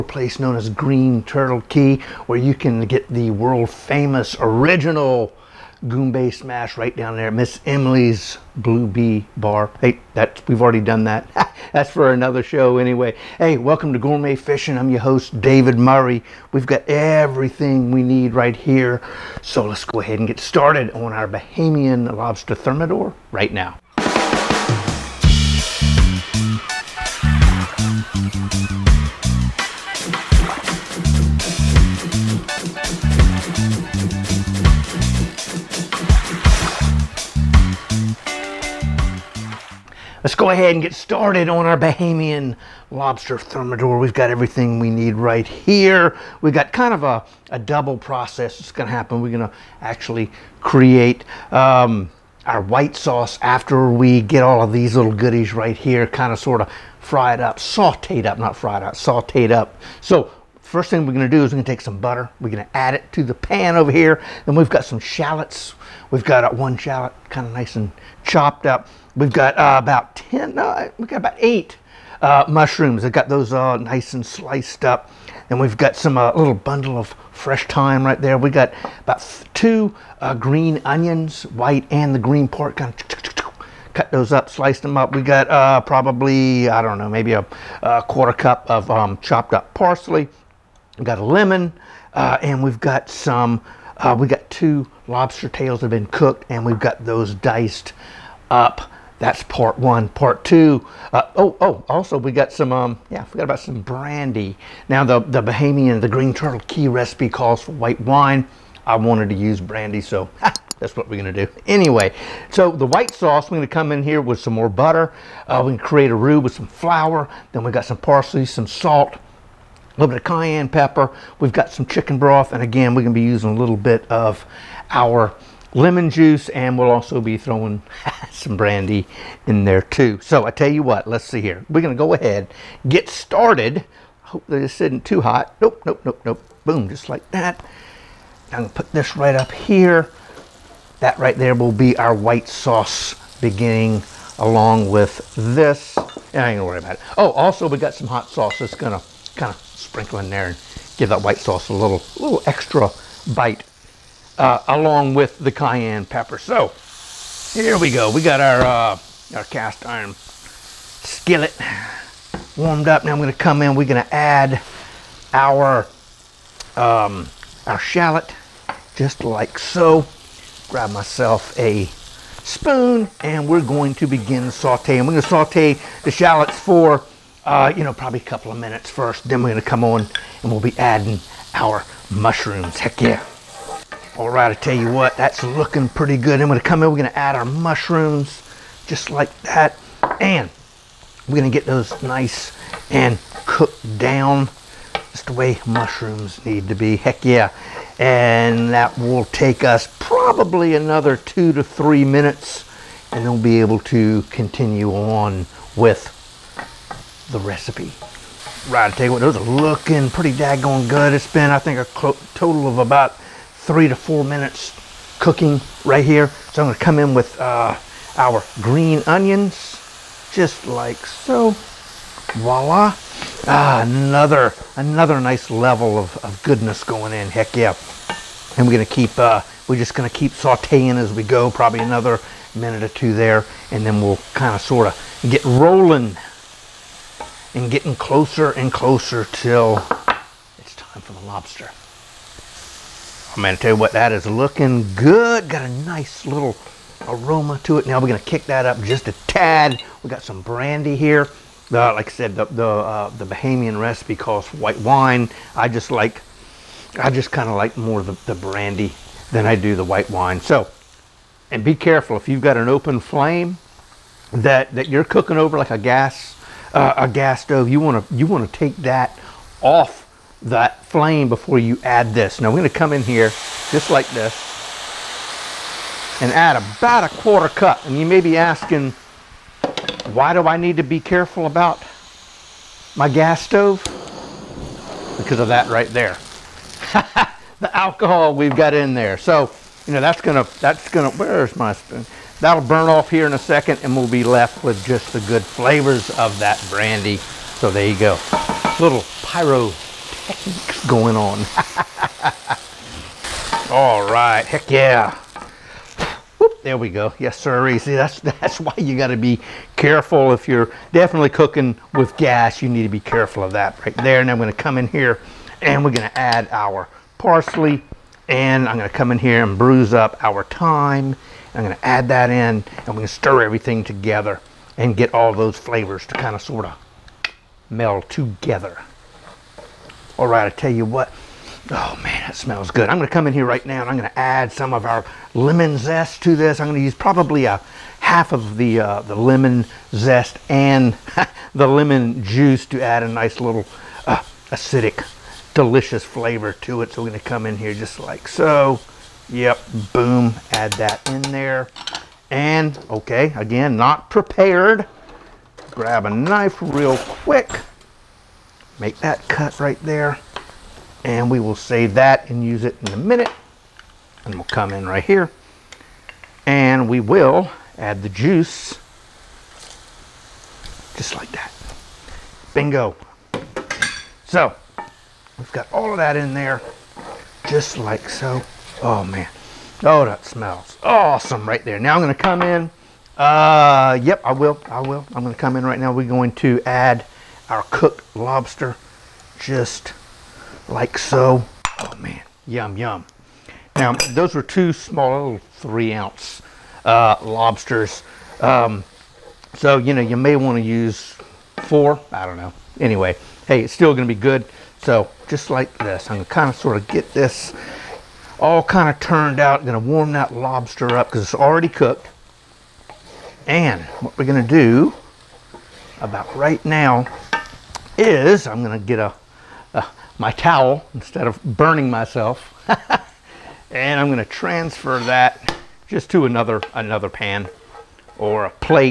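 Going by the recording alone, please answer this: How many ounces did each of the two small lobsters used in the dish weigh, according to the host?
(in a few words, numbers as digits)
3 ounces.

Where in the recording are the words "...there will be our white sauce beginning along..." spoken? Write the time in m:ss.
2:21.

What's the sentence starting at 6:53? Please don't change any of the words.
And what we're going to do about right now is I'm going to get a, a, my towel instead of burning myself.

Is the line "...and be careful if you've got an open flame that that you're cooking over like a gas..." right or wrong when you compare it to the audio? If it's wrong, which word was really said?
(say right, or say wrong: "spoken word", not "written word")
right.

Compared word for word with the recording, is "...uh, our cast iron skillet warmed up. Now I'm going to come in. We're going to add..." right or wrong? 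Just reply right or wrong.
right.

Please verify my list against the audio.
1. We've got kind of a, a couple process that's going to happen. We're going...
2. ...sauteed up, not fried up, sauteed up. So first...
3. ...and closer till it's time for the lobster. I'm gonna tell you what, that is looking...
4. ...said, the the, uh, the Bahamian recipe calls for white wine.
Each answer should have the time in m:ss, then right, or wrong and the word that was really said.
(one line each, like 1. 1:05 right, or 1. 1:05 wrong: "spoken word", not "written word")
1. 0:46 wrong: "double", not "couple"
2. 0:57 right
3. 3:58 right
4. 4:12 right.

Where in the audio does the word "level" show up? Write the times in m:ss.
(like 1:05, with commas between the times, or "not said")
3:45.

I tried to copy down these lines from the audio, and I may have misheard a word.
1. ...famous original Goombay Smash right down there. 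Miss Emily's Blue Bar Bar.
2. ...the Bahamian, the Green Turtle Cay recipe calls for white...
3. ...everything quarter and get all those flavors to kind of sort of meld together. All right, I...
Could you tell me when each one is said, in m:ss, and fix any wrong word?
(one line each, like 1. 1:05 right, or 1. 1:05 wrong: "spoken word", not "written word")
1. 0:03 wrong: "Bee", not "Bar"
2. 1:45 right
3. 5:23 wrong: "together", not "quarter".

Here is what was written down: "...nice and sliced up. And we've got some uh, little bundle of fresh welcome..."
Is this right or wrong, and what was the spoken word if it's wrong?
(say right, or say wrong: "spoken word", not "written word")
wrong: "thyme", not "welcome".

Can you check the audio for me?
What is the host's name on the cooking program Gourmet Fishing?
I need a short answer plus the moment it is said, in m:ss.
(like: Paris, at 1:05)
David Murray, at 0:15.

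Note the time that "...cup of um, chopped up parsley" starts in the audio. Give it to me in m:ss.
1:28.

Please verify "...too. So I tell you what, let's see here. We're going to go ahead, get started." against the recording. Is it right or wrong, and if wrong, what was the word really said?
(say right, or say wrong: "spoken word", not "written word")
right.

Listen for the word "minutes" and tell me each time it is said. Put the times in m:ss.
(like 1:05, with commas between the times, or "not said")
2:58, 3:22, 3:34, 3:52, 6:02.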